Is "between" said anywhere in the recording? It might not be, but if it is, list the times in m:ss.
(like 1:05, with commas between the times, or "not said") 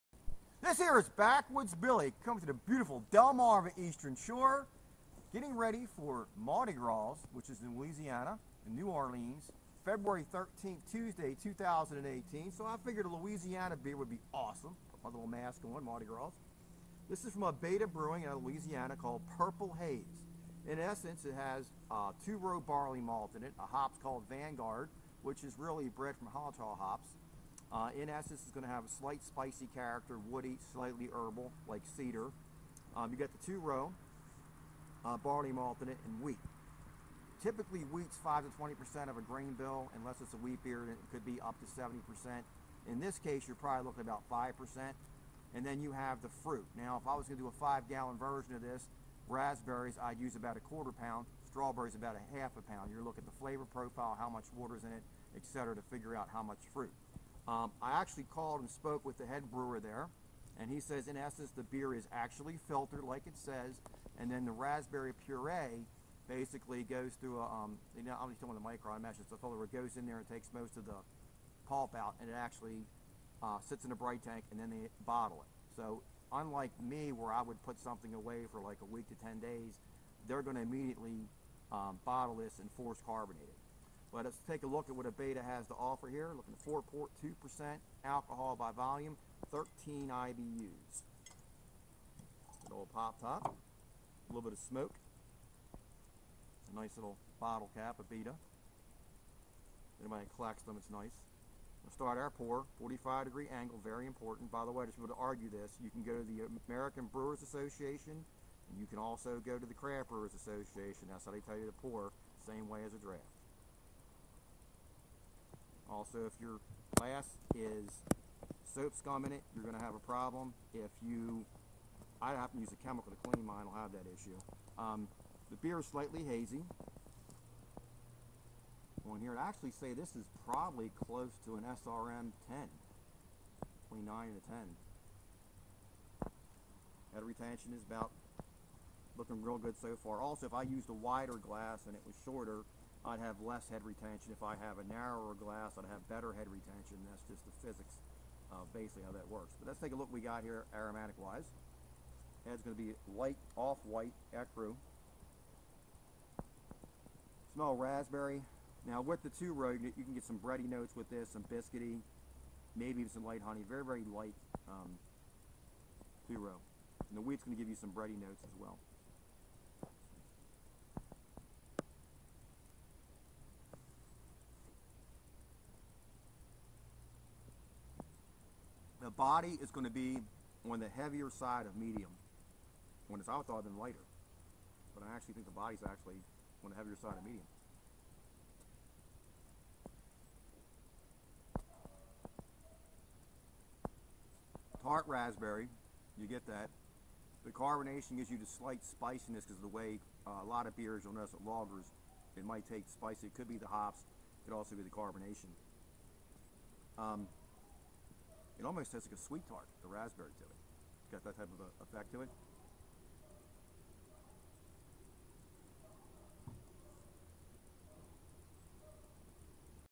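2:13.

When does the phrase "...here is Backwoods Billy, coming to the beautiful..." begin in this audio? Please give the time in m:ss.
0:00.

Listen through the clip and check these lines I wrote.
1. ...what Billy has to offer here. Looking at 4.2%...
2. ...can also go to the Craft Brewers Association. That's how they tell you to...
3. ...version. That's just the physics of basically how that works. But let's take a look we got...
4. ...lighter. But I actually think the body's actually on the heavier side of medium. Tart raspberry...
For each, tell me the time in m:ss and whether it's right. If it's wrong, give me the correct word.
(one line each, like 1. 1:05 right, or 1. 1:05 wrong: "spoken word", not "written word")
1. 1:24 wrong: "Abita", not "Billy"
2. 1:48 right
3. 2:26 wrong: "retention", not "version"
4. 3:03 right.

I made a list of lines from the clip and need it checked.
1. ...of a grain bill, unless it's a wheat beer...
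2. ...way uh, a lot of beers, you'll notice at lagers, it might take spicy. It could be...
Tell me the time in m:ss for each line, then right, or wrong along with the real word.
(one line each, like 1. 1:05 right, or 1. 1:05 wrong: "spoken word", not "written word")
1. 0:39 right
2. 3:19 right.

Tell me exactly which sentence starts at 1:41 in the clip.
We'll start our pour, 45 degree angle, very important.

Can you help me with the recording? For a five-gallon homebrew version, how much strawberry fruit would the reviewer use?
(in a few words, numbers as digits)
half a pound.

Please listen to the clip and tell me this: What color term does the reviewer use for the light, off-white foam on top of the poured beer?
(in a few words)
ecru.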